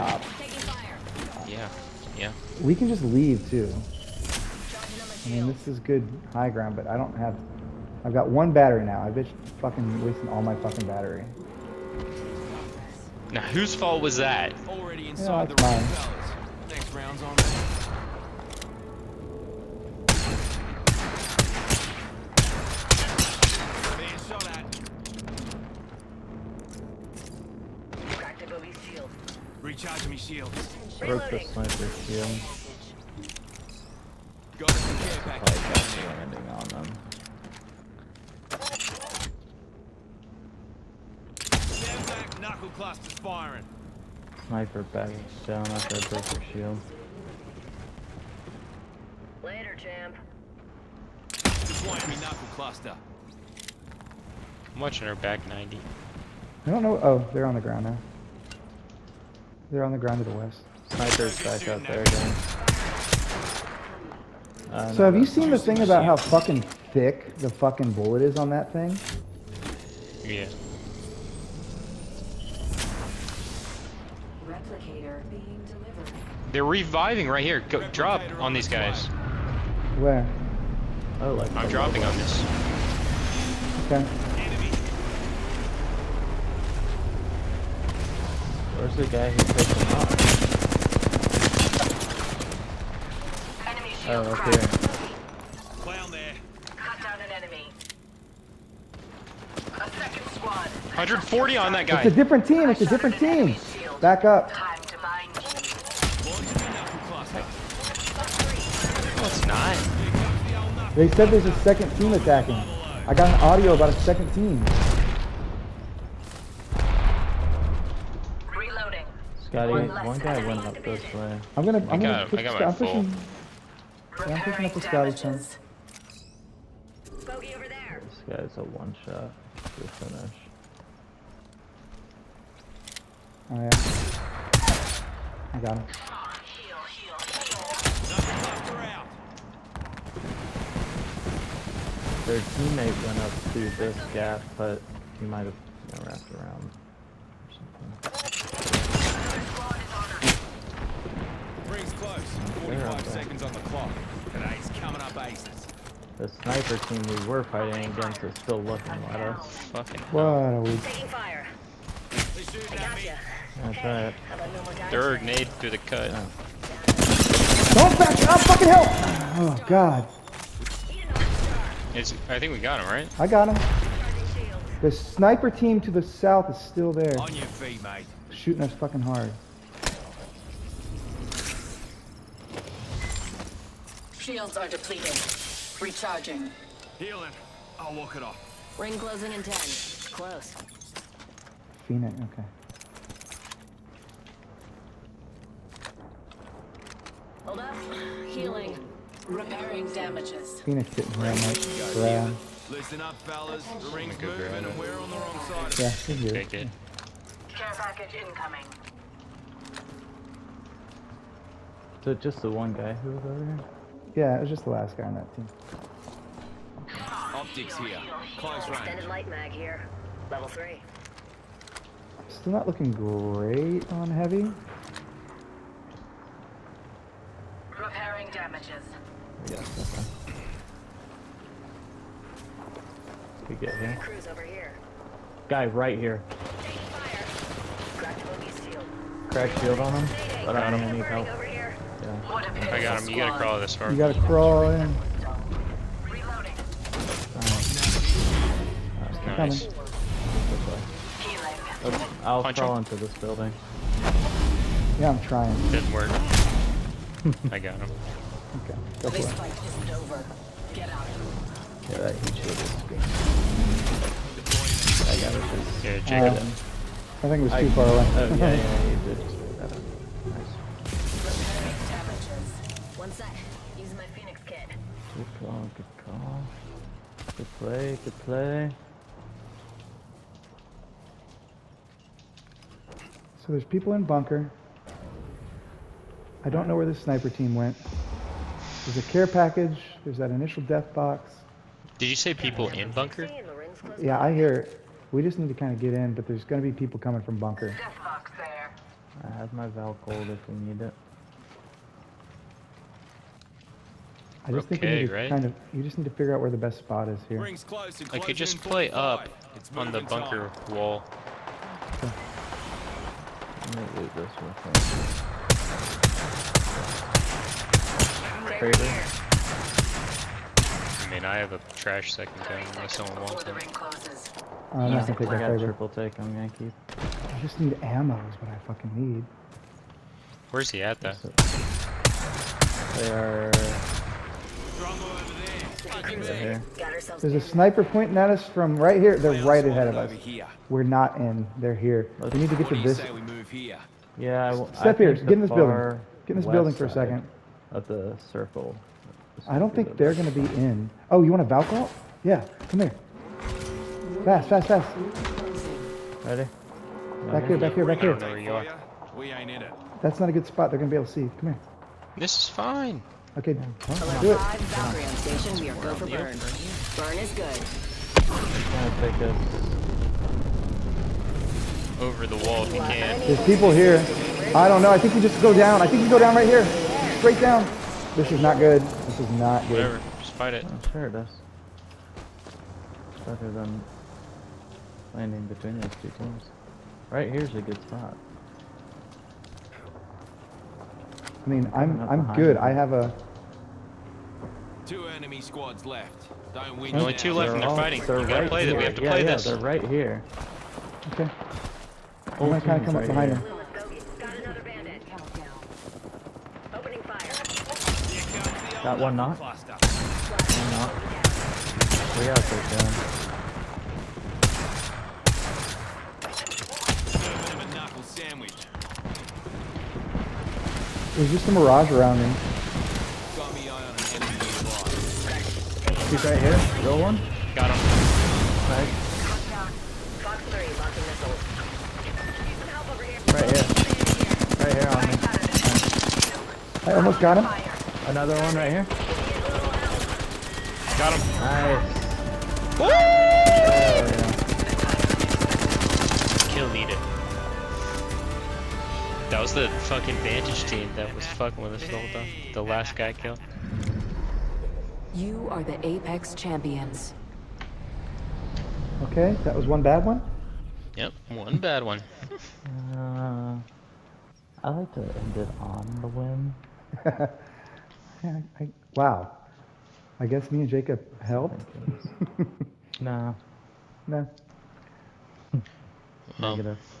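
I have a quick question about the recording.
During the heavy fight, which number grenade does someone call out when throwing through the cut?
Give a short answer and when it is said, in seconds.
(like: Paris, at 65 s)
Third, at 164 s.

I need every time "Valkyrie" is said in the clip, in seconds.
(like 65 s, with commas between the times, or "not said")
351 s, 364 s.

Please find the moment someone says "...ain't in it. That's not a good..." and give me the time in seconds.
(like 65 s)
359 s.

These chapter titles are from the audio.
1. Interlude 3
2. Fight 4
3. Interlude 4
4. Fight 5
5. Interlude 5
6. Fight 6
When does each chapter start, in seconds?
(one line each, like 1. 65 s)
1. 66 s
2. 76 s
3. 186 s
4. 231 s
5. 261 s
6. 306 s.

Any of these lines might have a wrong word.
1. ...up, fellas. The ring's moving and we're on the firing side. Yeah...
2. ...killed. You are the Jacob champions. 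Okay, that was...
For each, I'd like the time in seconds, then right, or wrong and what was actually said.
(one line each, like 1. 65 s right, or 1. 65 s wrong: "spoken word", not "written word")
1. 203 s wrong: "wrong", not "firing"
2. 453 s wrong: "Apex", not "Jacob".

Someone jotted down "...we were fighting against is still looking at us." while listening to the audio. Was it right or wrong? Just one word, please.
right.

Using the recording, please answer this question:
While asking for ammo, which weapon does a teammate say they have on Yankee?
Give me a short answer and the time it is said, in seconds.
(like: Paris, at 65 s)
Triple Take, at 325 s.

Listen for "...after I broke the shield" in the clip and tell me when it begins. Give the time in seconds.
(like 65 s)
45 s.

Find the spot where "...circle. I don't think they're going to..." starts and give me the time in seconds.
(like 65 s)
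348 s.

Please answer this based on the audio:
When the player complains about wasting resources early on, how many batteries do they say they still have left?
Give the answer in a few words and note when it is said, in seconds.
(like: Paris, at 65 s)
1, at 8 s.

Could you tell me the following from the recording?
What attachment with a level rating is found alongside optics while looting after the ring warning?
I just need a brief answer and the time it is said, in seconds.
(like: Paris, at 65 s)
Extended light mag, at 218 s.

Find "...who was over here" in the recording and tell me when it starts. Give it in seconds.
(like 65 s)
212 s.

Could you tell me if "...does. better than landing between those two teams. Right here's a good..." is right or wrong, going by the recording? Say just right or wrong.
right.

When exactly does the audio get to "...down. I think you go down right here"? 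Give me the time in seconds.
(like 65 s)
375 s.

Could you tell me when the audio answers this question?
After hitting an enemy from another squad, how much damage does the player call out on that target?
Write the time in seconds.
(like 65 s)
100 s.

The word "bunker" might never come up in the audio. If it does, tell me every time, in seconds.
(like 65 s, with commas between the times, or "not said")
284 s, 292 s, 297 s, 310 s.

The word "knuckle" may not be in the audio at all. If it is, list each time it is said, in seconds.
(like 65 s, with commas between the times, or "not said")
42 s, 52 s.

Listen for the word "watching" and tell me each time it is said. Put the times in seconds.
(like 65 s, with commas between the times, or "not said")
54 s.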